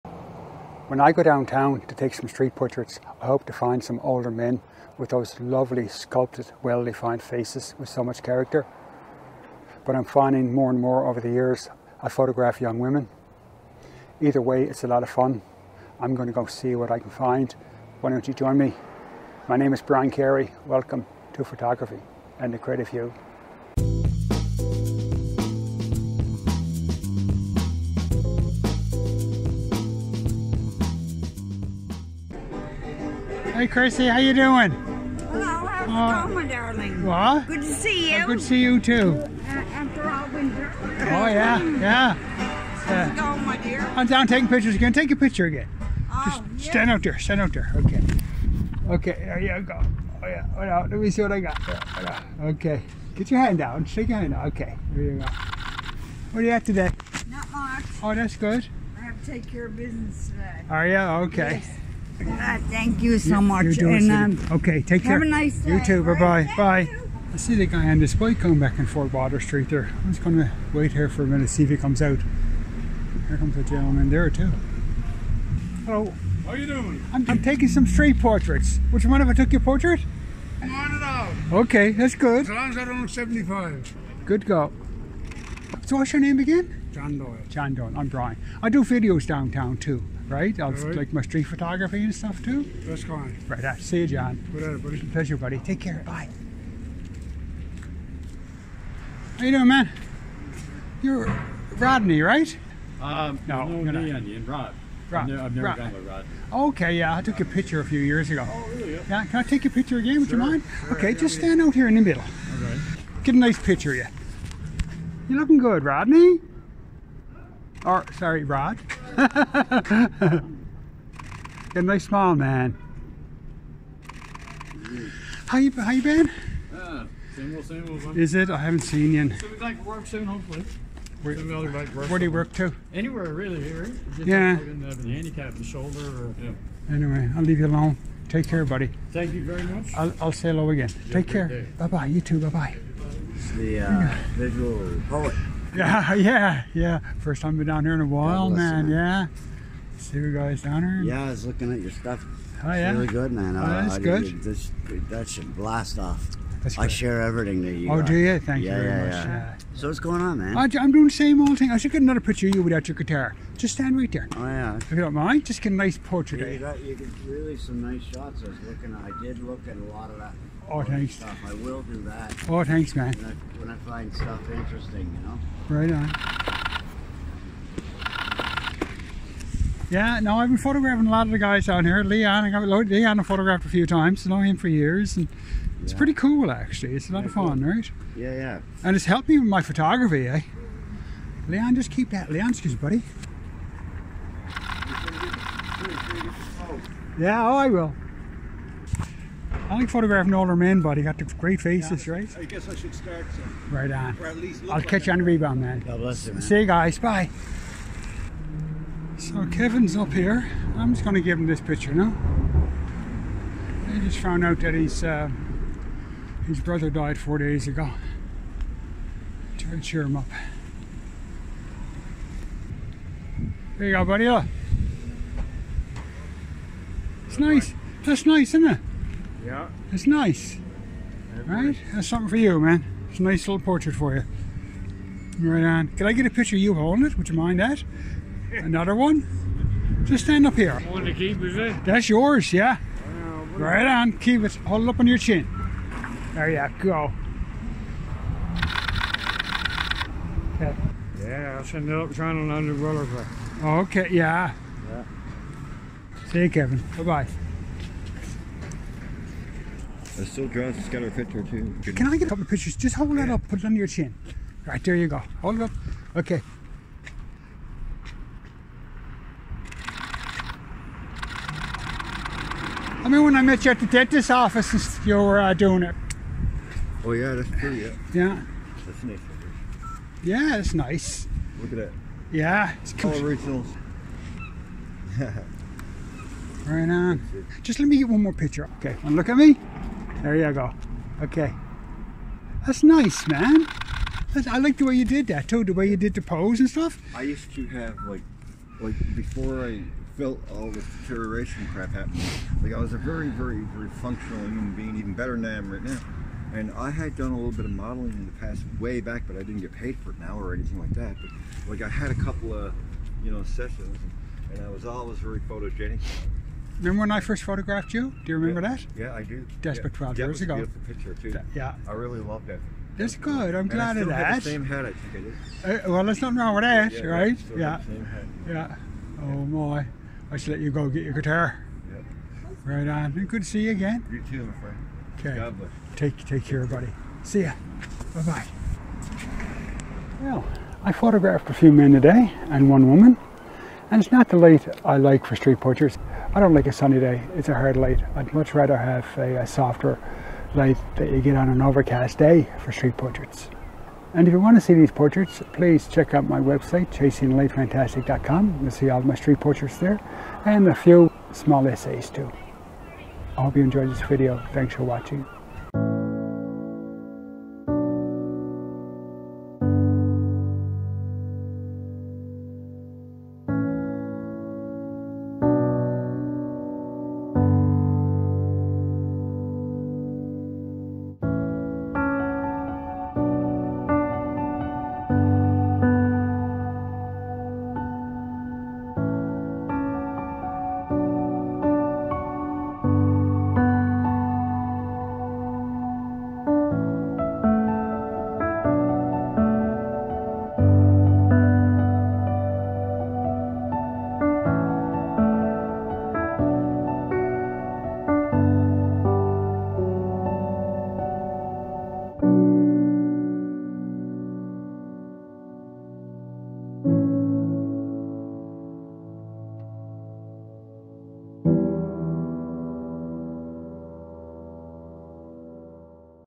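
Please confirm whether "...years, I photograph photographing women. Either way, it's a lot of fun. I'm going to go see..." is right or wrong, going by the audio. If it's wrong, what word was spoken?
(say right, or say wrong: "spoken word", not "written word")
wrong: "young", not "photographing".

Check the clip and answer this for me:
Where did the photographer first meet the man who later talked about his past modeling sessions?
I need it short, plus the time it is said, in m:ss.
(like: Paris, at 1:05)
the dentist office, at 4:33.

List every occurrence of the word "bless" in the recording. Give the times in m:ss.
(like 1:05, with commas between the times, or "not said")
3:26, 5:35.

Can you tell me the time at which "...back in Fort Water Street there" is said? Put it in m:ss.
1:08.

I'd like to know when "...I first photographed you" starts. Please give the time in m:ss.
5:17.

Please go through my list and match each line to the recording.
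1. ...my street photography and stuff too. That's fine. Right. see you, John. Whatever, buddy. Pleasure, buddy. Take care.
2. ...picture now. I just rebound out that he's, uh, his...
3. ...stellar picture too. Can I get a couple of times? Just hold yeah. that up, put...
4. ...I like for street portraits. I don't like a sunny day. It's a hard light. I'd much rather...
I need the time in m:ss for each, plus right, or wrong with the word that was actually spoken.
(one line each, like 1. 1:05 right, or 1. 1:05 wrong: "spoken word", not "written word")
1. 1:31 right
2. 3:31 wrong: "found", not "rebound"
3. 4:20 wrong: "pictures", not "times"
4. 5:44 right.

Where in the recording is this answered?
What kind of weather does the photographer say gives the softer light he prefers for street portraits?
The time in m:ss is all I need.
5:51.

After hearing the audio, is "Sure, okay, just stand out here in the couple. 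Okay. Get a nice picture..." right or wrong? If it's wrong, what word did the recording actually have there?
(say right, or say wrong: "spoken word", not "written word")
wrong: "middle", not "couple".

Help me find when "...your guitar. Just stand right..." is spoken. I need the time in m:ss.
2:42.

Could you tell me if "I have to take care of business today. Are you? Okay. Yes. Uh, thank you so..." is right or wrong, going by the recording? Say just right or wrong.
right.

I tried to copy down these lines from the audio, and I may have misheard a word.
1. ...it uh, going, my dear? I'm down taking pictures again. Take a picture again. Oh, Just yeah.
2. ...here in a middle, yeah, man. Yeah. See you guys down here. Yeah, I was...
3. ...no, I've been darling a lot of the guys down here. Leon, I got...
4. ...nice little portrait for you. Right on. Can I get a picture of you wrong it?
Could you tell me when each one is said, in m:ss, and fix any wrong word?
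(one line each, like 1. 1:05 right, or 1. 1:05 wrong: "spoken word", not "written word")
1. 0:43 right
2. 2:27 wrong: "while", not "middle"
3. 3:00 wrong: "photographing", not "darling"
4. 3:53 wrong: "holding", not "wrong".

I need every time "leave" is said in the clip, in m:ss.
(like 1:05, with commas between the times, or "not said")
2:17.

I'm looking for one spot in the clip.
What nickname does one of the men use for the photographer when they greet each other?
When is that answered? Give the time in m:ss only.
2:24.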